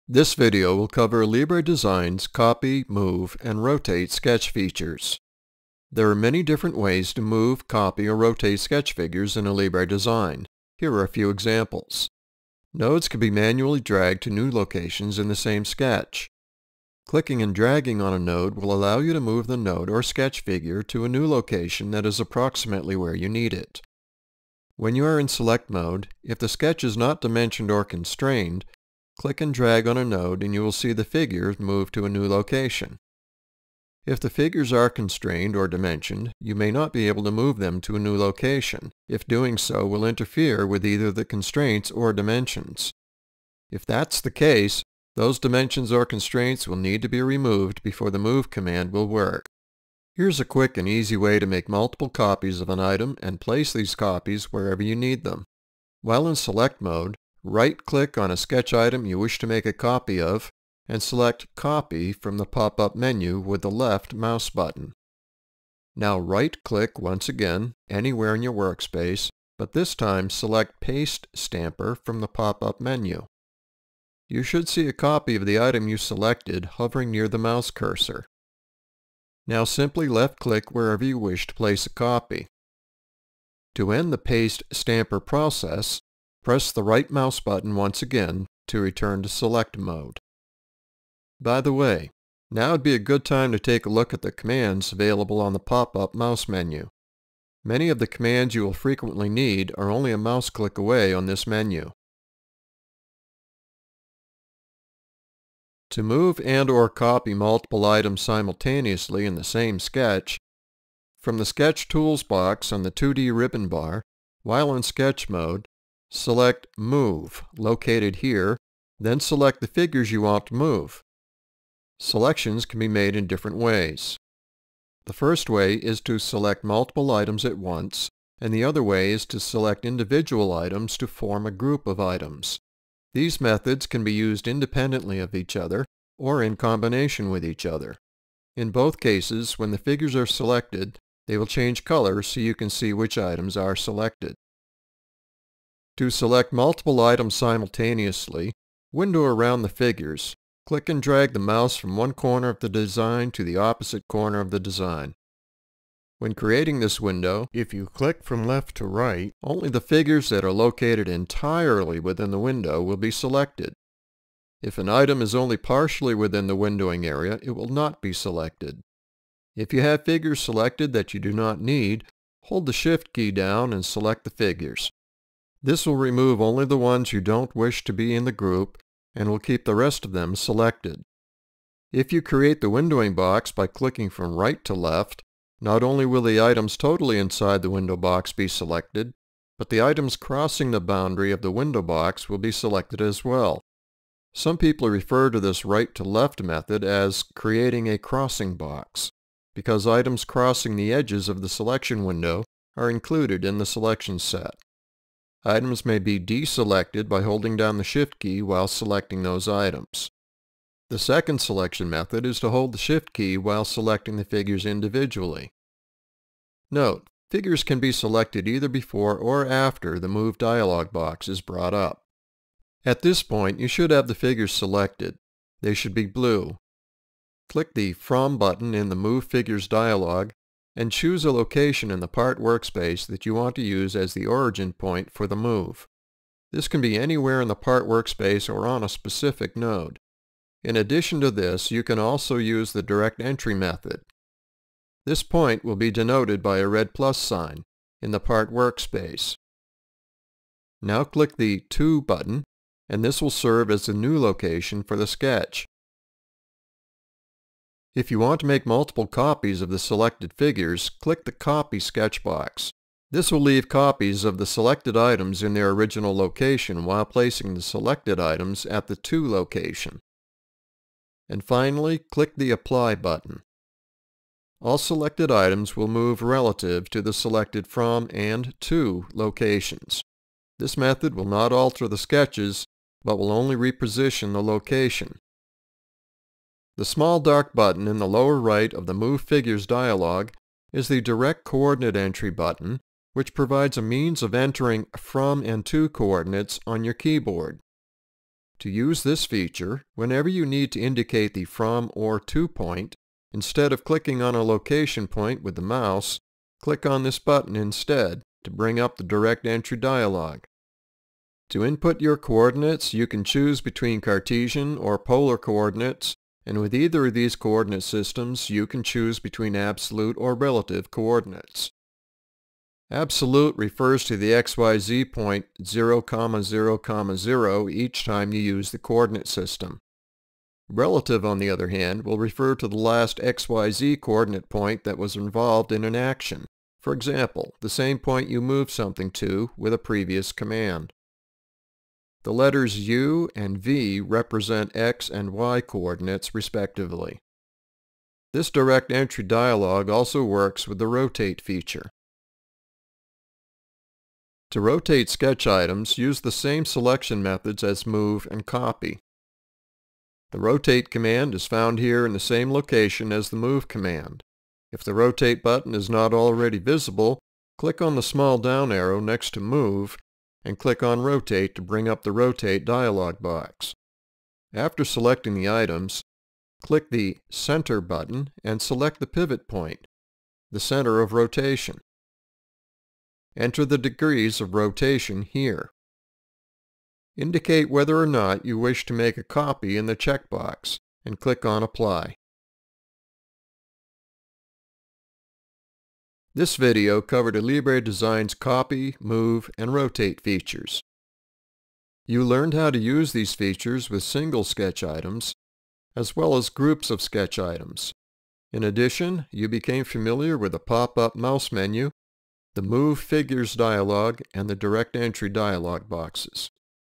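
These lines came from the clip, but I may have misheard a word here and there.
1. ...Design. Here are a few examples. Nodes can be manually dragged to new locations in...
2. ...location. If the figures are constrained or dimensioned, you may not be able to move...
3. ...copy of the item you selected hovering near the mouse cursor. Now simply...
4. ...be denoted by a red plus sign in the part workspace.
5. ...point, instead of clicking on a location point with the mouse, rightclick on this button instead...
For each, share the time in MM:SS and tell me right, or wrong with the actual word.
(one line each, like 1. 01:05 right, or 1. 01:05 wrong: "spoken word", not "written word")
1. 00:09 right
2. 00:32 right
3. 01:14 right
4. 04:05 right
5. 05:02 wrong: "click", not "rightclick".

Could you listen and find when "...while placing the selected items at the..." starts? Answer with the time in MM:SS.
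04:26.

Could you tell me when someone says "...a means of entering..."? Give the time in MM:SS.
04:53.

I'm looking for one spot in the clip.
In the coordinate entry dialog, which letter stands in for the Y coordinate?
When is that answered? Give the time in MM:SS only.
05:43.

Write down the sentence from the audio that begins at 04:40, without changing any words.
This method will not alter the sketches, but will only reposition the location.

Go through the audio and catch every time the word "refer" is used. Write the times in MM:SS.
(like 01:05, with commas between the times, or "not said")
03:14, 05:23, 05:32.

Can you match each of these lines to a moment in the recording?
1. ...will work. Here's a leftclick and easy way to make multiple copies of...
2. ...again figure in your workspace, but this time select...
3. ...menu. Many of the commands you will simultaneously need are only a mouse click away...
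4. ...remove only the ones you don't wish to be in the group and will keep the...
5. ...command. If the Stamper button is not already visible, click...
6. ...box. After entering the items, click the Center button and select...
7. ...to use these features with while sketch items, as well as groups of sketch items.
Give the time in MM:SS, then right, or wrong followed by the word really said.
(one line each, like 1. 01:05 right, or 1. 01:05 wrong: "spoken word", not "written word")
1. 00:48 wrong: "quick", not "leftclick"
2. 01:07 wrong: "anywhere", not "figure"
3. 01:36 wrong: "frequently", not "simultaneously"
4. 02:55 right
5. 06:03 wrong: "Rotate", not "Stamper"
6. 06:13 wrong: "selecting", not "entering"
7. 06:42 wrong: "single", not "while".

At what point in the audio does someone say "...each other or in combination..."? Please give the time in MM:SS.
02:15.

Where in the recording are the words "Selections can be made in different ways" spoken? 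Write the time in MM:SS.
02:02.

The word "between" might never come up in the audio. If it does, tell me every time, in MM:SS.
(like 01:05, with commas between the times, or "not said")
05:13, 05:19.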